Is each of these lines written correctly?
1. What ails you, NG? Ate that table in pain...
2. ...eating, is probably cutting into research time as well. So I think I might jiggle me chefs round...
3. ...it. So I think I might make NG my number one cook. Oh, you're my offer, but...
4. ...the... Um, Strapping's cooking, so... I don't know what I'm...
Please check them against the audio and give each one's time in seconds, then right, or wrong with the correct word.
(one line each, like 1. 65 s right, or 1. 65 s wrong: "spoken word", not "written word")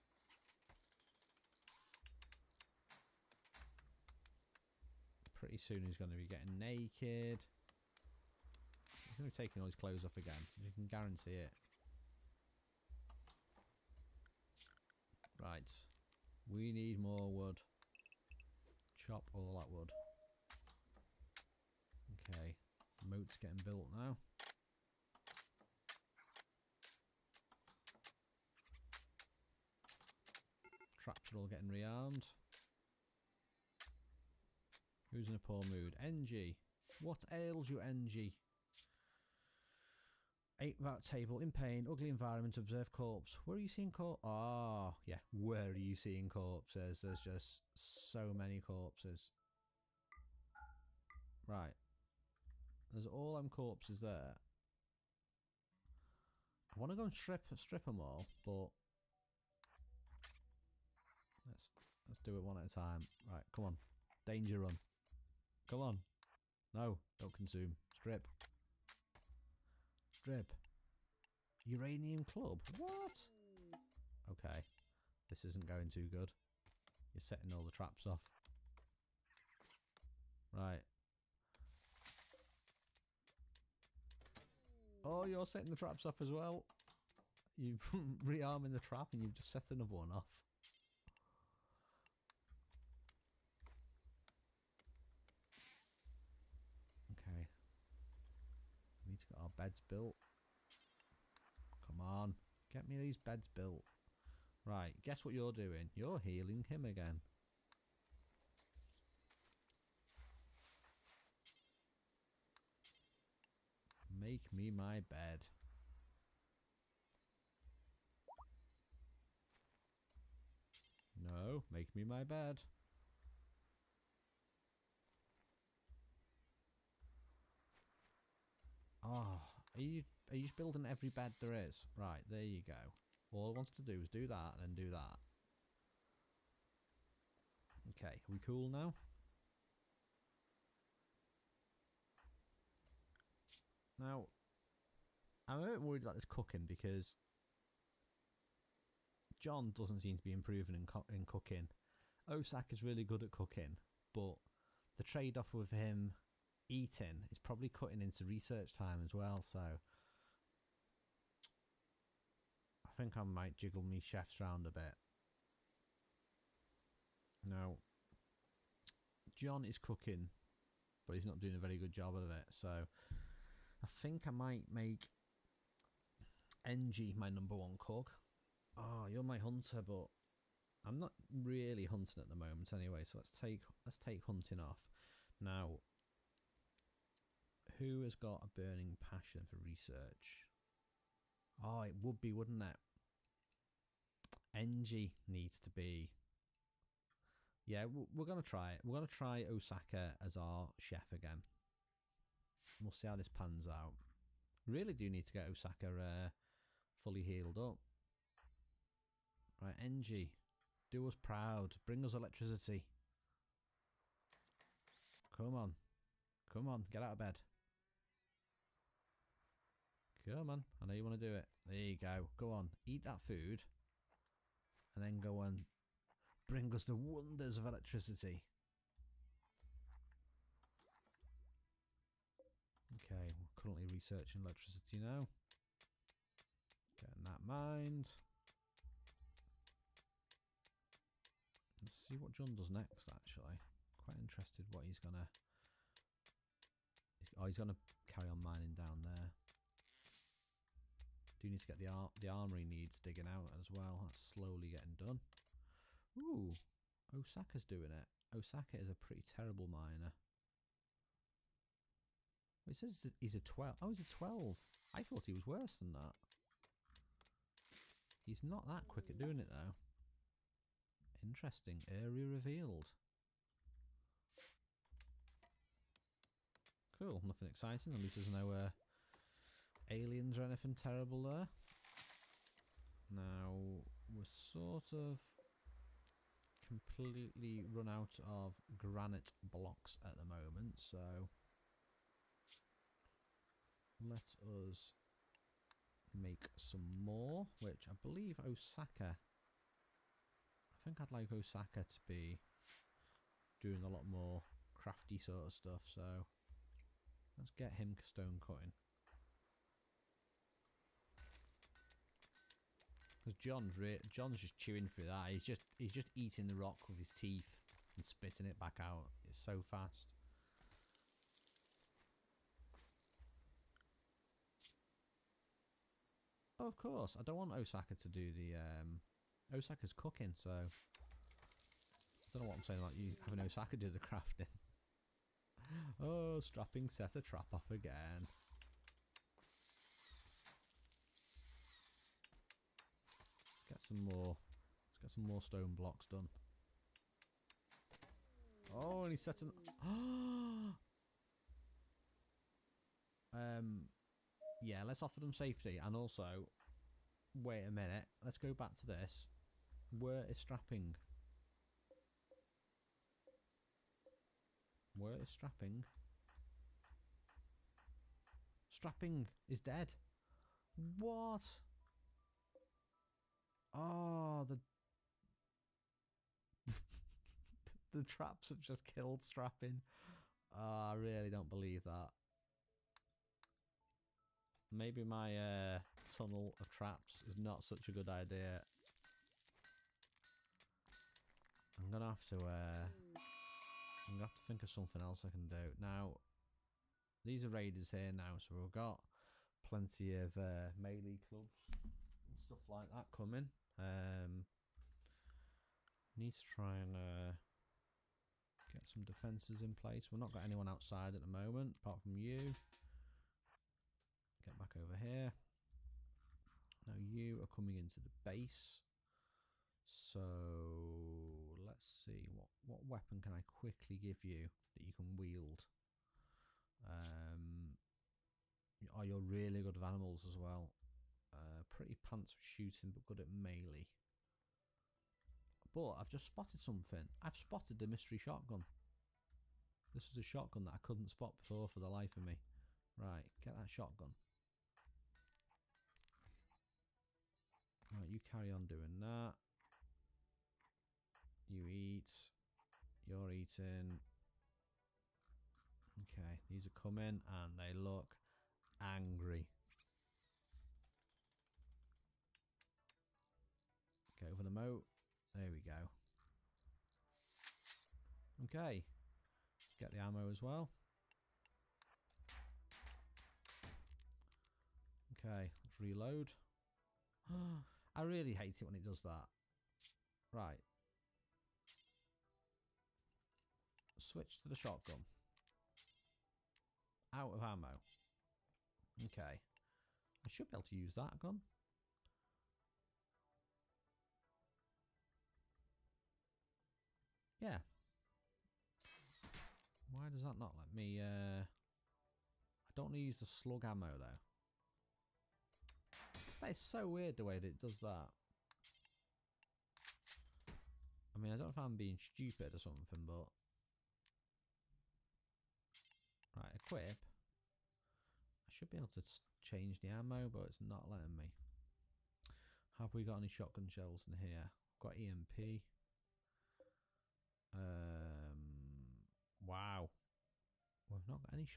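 1. 37 s right
2. 156 s right
3. 172 s wrong: "hunter", not "offer"
4. 328 s wrong: "Osaka", not "Strapping".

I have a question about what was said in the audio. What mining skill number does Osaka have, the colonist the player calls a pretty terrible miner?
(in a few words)
12.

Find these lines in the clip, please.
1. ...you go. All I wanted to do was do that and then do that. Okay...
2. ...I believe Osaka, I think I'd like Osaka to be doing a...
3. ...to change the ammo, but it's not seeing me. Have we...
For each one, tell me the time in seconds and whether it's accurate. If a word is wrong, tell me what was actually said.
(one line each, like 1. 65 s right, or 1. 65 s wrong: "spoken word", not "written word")
1. 132 s right
2. 297 s right
3. 518 s wrong: "letting", not "seeing".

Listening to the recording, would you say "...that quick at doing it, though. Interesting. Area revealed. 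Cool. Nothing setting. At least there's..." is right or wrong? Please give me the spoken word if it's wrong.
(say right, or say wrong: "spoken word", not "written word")
wrong: "exciting", not "setting".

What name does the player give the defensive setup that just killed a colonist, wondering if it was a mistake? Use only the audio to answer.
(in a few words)
tunnel of traps.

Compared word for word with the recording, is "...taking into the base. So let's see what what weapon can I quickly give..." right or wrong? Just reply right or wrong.
wrong.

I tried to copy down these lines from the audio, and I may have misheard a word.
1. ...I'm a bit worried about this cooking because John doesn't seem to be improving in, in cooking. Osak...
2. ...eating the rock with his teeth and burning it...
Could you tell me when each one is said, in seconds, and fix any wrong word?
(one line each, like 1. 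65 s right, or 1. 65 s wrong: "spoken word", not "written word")
1. 145 s right
2. 316 s wrong: "spitting", not "burning".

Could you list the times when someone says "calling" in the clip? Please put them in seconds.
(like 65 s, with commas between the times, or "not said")
not said.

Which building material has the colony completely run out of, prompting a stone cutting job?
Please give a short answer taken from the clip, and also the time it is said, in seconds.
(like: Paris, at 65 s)
granite blocks, at 288 s.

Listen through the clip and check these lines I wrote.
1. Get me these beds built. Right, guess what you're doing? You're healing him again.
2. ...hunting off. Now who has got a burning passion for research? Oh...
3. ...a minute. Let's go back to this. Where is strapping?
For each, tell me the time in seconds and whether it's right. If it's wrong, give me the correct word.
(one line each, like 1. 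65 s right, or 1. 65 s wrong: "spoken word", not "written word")
1. 102 s right
2. 184 s right
3. 357 s right.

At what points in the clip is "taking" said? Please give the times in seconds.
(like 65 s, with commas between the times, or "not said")
9 s.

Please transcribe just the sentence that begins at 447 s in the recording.
Right, you carry on doing that.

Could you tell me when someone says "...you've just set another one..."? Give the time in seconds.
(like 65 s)
89 s.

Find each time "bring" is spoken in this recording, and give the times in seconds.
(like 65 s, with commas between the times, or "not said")
211 s, 226 s.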